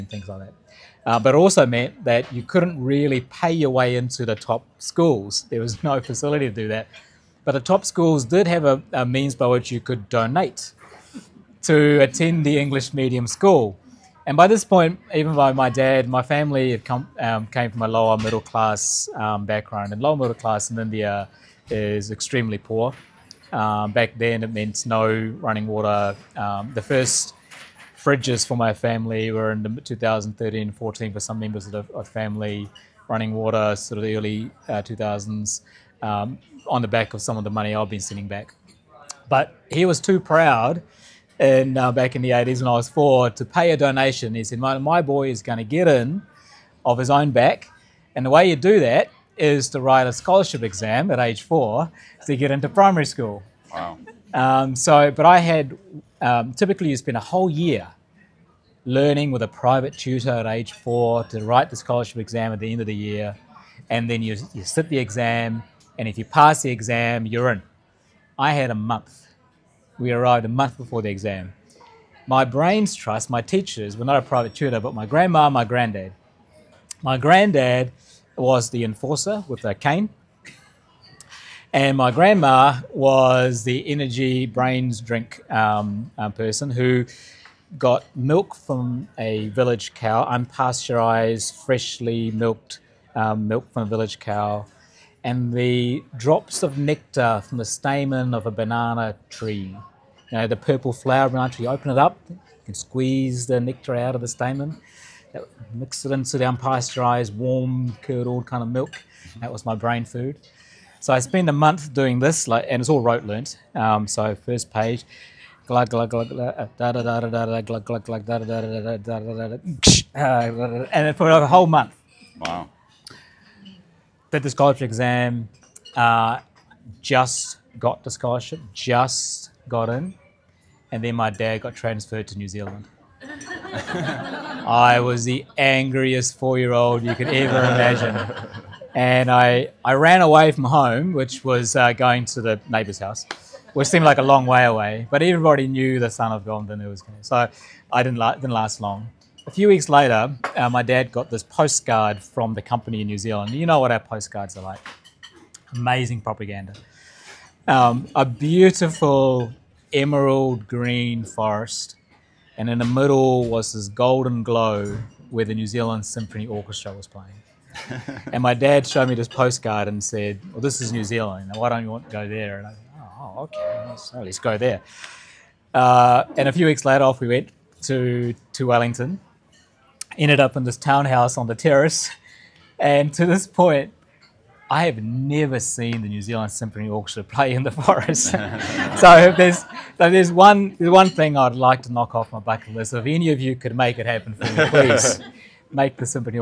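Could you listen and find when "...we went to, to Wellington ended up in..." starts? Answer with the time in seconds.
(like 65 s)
177 s.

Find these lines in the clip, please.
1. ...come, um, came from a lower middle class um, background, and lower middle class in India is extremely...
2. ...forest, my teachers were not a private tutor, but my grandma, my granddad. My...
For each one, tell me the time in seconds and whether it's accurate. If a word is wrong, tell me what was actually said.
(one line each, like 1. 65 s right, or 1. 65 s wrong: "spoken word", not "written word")
1. 16 s right
2. 72 s wrong: "trust", not "forest".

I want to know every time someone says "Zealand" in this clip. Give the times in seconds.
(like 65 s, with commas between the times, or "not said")
132 s, 153 s, 165 s, 171 s, 186 s.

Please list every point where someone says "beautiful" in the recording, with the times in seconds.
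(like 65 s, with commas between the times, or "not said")
158 s.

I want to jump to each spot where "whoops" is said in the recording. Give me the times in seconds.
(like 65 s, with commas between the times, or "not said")
not said.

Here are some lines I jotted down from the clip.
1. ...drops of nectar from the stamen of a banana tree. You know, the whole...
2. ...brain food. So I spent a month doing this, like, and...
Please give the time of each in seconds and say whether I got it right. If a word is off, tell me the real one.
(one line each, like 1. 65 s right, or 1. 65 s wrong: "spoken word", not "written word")
1. 96 s wrong: "purple", not "whole"
2. 109 s right.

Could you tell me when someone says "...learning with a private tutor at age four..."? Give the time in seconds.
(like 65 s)
58 s.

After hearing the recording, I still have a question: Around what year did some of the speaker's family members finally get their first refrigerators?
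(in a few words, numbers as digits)
2013.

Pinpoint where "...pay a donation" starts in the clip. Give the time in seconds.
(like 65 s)
43 s.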